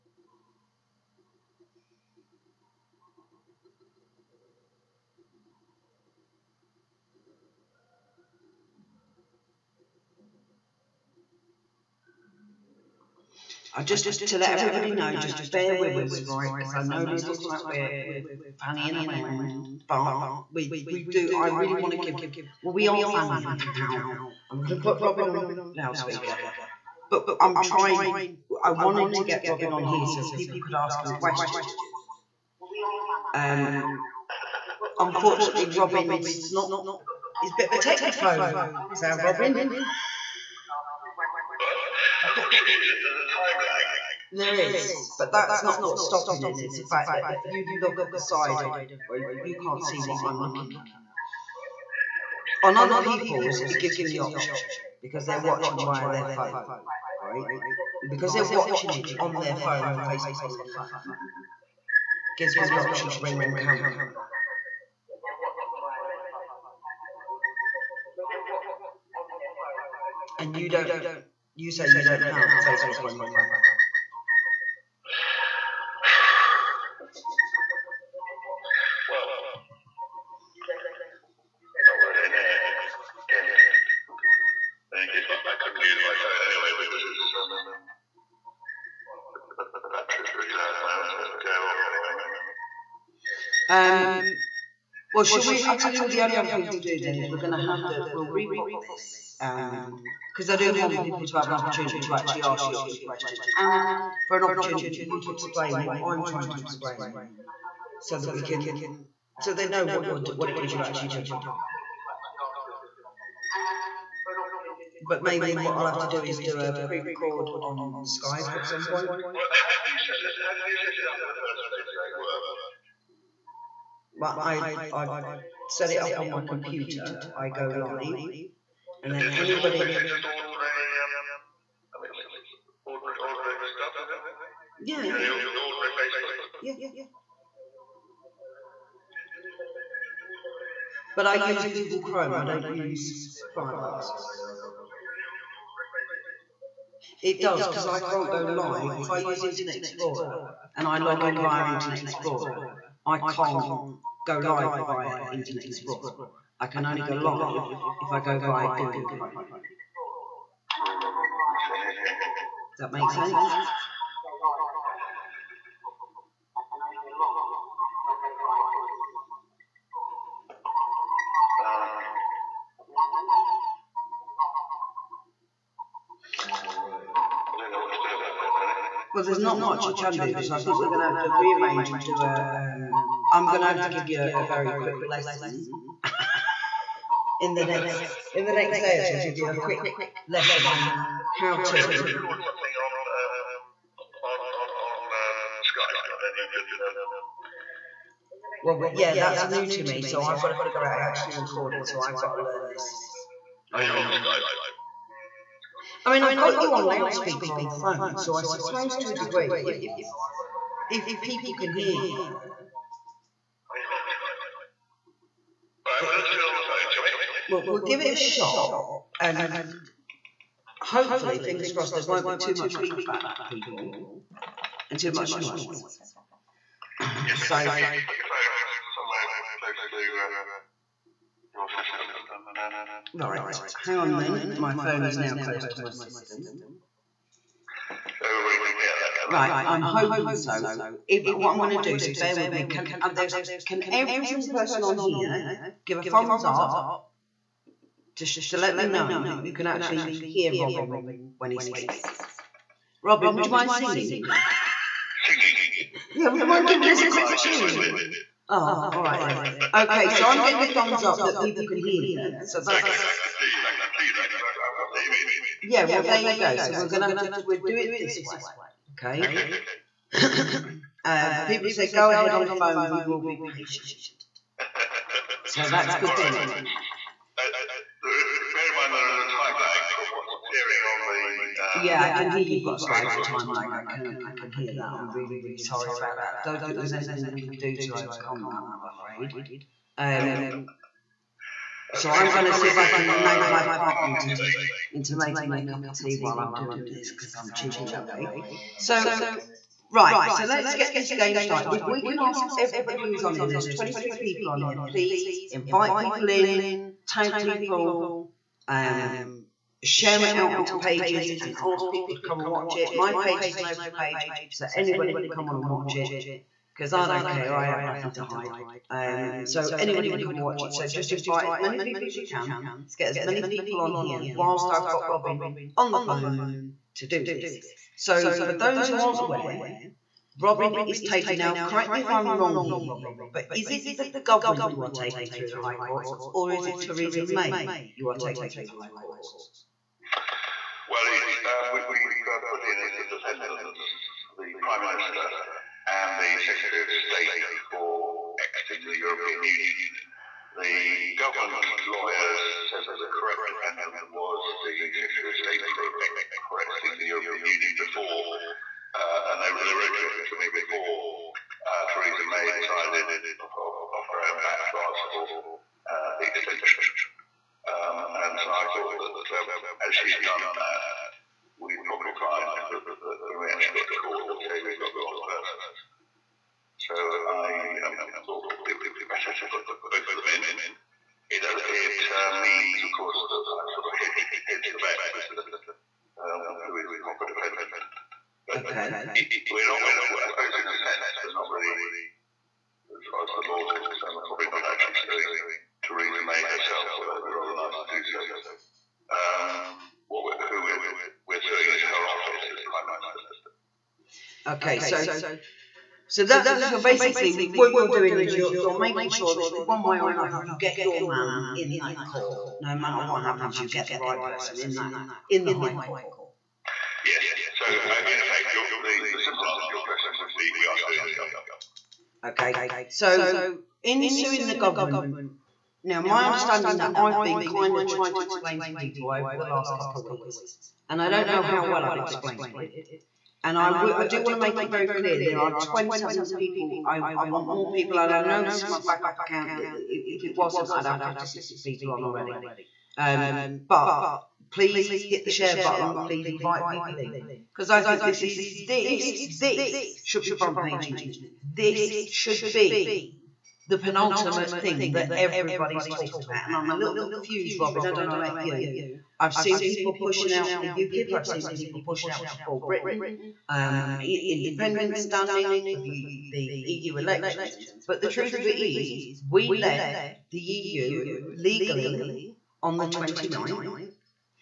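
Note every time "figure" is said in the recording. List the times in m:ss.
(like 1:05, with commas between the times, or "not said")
3:20.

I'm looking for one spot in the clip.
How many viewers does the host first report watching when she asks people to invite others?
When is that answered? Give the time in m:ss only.
5:03.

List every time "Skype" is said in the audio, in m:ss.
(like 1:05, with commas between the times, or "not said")
1:58, 3:15, 3:24.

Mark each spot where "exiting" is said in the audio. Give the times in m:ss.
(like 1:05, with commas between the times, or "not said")
5:48, 5:56.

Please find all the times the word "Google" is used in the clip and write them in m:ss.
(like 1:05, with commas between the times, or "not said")
2:21, 2:38.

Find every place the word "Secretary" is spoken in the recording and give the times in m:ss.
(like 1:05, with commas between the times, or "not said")
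5:46, 5:54.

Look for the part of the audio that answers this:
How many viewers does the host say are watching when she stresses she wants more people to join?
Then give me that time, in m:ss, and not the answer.
7:15.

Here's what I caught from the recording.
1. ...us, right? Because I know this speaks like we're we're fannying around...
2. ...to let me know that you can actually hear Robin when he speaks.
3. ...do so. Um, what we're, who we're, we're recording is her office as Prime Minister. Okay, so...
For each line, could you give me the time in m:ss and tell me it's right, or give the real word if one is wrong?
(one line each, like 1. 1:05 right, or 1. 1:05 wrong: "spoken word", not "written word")
1. 0:15 wrong: "looks", not "speaks"
2. 4:08 right
3. 6:37 wrong: "suing", not "recording".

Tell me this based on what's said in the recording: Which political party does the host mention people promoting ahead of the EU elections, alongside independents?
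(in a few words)
UKIP.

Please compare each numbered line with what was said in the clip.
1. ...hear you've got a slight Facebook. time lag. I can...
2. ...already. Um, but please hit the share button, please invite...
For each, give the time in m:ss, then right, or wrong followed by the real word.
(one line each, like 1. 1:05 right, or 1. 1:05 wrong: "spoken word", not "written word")
1. 4:42 right
2. 7:22 right.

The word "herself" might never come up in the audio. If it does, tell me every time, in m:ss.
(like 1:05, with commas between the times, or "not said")
6:36.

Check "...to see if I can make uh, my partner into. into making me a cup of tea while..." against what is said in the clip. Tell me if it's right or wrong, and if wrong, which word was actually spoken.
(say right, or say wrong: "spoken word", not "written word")
right.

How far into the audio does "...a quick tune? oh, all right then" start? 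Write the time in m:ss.
4:17.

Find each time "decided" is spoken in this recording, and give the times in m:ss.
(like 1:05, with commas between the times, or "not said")
6:02.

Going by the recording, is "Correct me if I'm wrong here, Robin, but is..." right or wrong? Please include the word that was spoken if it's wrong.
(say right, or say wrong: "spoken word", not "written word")
right.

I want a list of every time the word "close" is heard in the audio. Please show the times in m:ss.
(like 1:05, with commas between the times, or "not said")
3:49, 3:55.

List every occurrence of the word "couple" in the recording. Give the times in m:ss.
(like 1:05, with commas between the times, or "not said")
7:09.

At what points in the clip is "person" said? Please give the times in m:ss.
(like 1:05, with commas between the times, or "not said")
4:04, 6:15, 6:54.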